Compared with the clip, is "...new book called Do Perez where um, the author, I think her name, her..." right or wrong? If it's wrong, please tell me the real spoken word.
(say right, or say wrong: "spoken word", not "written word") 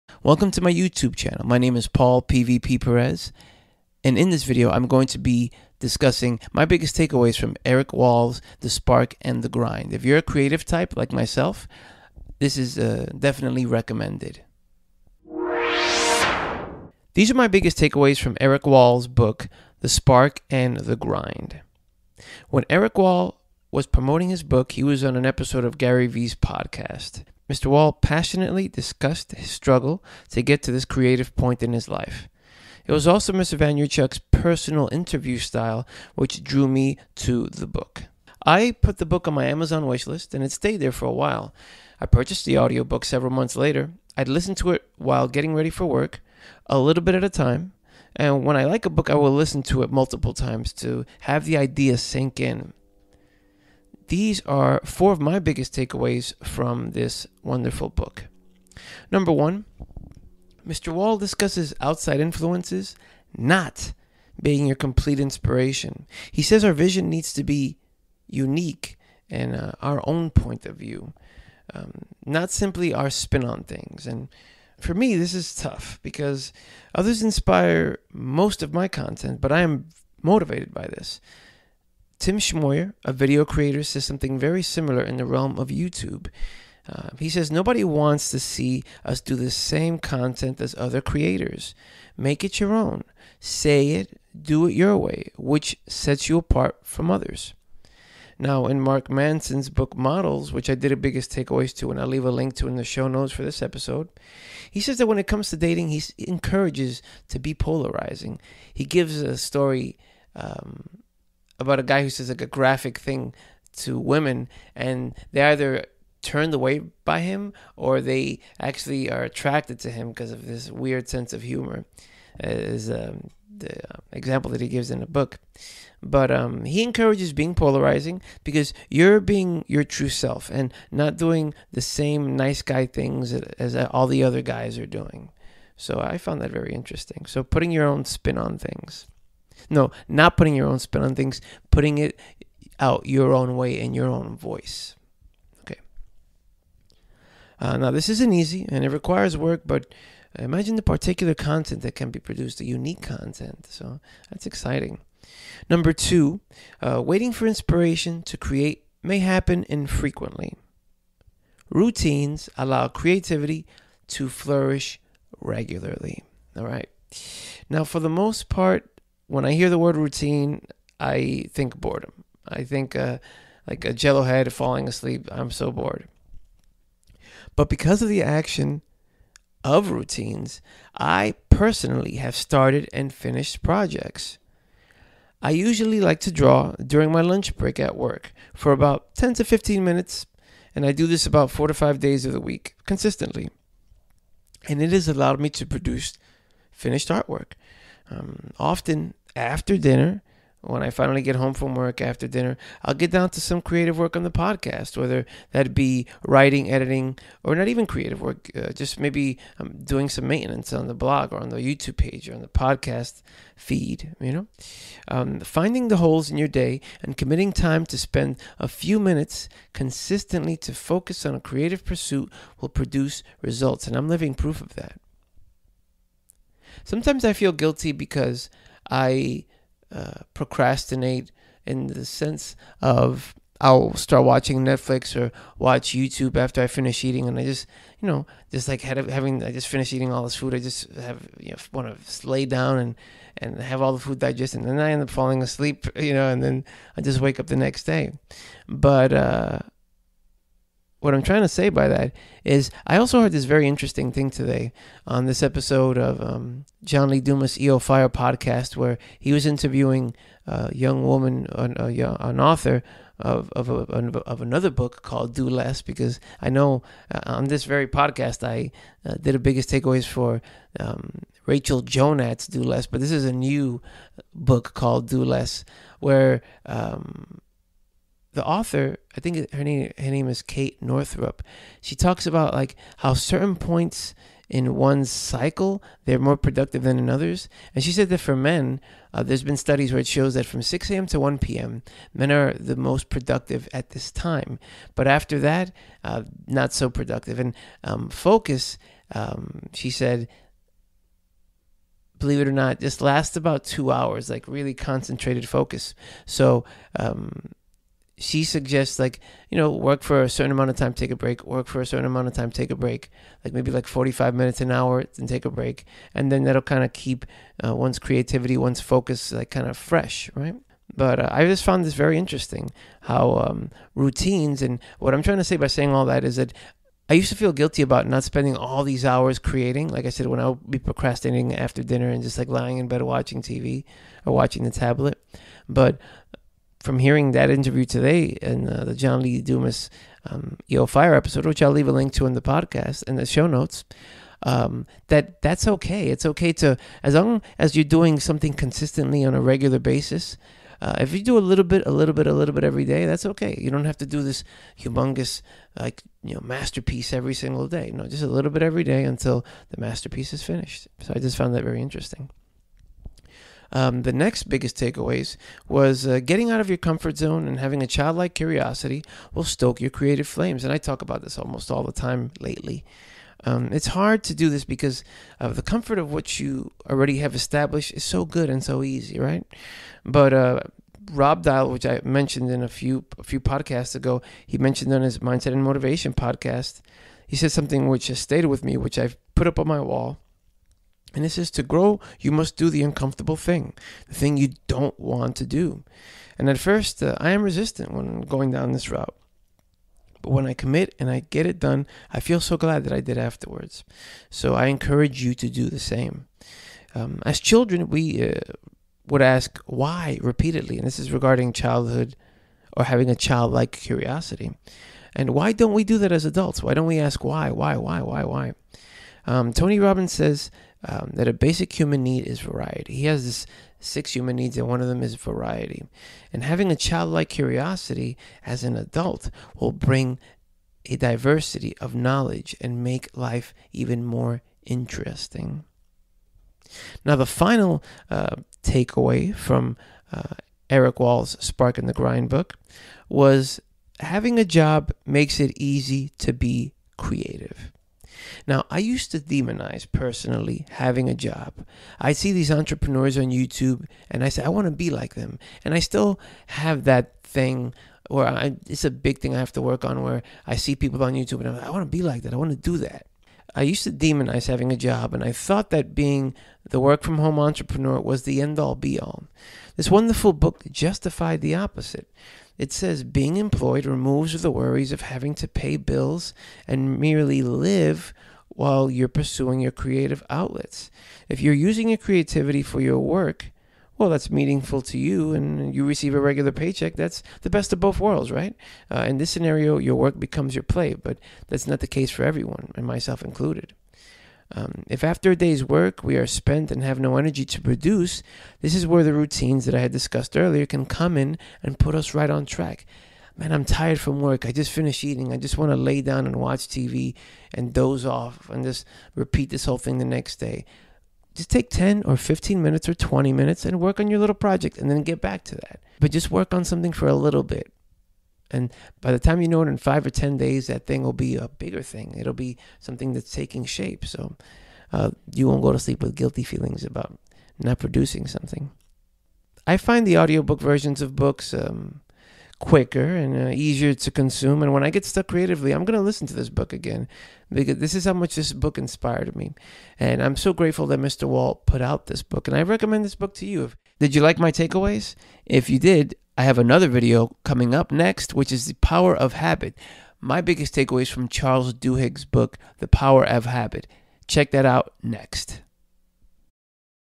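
wrong: "Less", not "Perez".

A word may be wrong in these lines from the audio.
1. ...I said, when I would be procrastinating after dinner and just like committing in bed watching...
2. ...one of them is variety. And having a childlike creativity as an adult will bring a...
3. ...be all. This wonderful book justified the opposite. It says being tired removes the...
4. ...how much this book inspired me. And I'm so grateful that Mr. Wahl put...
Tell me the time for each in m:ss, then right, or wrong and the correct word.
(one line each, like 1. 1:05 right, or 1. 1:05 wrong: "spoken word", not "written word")
1. 5:30 wrong: "lying", not "committing"
2. 7:04 wrong: "curiosity", not "creativity"
3. 7:48 wrong: "employed", not "tired"
4. 8:58 right.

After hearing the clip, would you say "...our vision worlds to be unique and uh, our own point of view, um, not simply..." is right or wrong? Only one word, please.
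wrong.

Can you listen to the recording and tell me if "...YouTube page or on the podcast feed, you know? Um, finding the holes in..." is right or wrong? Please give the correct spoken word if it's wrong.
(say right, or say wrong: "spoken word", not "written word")
right.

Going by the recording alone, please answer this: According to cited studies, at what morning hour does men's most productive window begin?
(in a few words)
6 a.m.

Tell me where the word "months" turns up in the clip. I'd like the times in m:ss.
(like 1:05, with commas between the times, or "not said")
0:43.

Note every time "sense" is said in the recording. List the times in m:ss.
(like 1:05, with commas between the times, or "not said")
2:01, 3:52.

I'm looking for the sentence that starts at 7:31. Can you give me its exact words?
I see these entrepreneurs on YouTube and I say, I want to be like them.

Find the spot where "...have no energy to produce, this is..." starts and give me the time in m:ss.
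8:16.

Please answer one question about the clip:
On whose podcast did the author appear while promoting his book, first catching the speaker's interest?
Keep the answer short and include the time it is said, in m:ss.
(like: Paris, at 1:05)
Gary Vee, at 0:25.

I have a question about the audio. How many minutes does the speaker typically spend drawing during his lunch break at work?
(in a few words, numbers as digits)
10 to 15.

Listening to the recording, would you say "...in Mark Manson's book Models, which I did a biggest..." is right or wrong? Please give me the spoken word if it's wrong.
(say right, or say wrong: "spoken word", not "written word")
right.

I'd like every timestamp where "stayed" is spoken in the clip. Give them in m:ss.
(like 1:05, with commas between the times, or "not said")
0:40, 6:28.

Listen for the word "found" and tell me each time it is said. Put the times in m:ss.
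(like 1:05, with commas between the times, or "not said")
2:16, 5:21, 6:01.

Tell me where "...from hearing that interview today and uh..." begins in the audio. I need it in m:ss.
5:36.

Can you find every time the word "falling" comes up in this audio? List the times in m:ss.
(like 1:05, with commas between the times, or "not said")
2:54, 4:05.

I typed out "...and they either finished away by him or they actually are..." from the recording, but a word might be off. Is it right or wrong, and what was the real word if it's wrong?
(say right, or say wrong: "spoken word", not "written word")
wrong: "turned", not "finished".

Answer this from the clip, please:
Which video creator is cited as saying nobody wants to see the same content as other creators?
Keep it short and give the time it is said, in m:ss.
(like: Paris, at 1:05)
Tim Schmoyer, at 1:22.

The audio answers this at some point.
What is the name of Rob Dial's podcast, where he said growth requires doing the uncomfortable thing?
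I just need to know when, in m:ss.
6:25.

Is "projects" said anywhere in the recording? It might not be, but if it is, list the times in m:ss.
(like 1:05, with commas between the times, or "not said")
3:03, 8:34.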